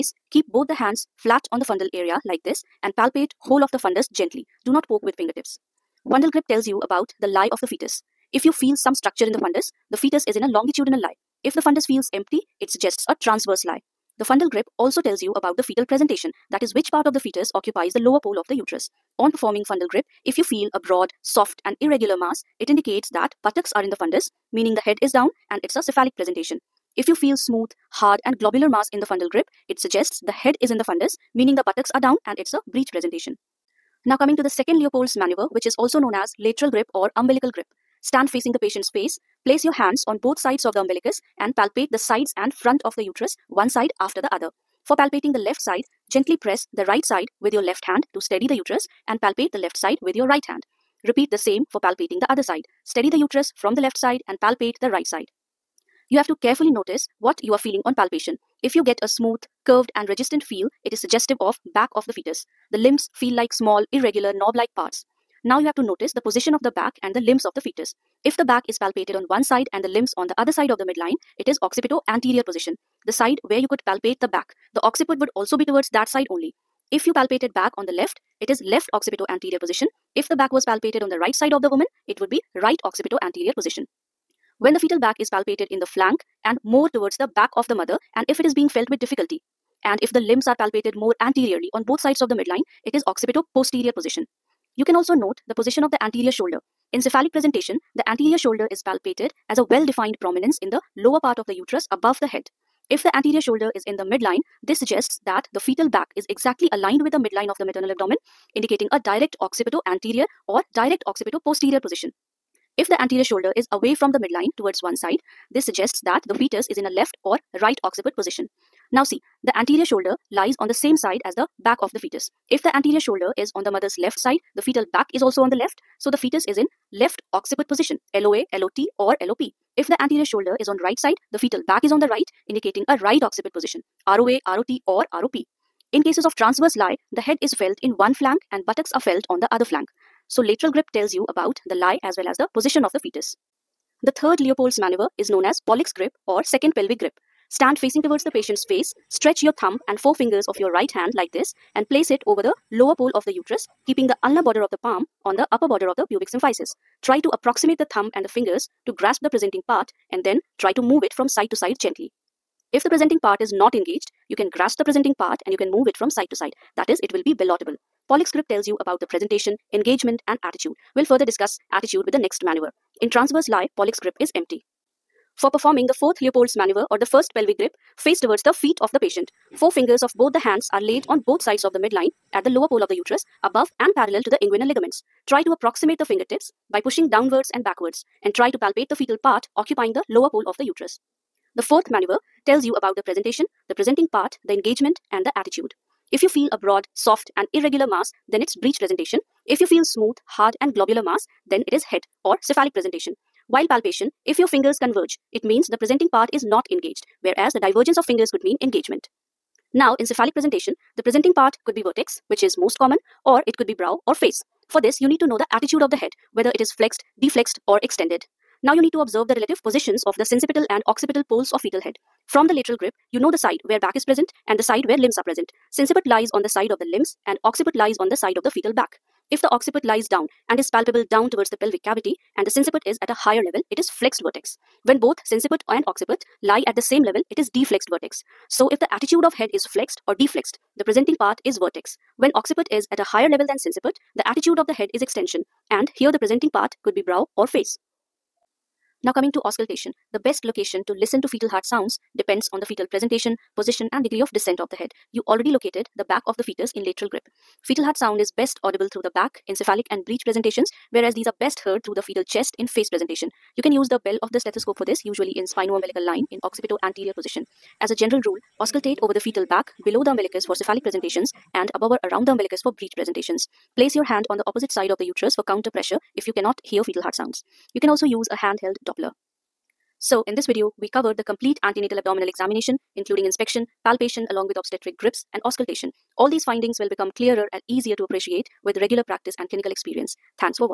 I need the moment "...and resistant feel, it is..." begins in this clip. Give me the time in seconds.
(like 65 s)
59 s.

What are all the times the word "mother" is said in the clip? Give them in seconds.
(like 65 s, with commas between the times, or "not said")
87 s, 123 s.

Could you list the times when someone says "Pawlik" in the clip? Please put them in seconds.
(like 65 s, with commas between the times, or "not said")
145 s, 168 s, 173 s.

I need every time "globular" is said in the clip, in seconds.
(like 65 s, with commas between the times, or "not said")
28 s, 200 s.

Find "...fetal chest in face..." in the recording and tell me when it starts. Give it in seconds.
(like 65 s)
262 s.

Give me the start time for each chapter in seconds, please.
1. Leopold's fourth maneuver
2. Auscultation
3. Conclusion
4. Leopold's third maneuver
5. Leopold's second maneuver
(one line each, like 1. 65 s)
1. 174 s
2. 248 s
3. 279 s
4. 143 s
5. 33 s.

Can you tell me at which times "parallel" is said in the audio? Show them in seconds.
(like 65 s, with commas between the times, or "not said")
183 s.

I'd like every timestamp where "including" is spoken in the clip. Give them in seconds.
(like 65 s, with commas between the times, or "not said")
282 s.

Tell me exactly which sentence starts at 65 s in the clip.
Now you have to notice the position of the back and the limbs of the fetus.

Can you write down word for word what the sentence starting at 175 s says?
For performing the fourth Leopold's maneuver or the first pelvic grip, face towards the feet of the patient.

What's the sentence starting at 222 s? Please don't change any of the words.
From the lateral grip, you know the side where back is present and the side where limbs are present.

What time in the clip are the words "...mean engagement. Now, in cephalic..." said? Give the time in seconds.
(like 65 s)
208 s.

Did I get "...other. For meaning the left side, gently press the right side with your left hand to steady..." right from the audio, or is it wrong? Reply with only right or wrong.
wrong.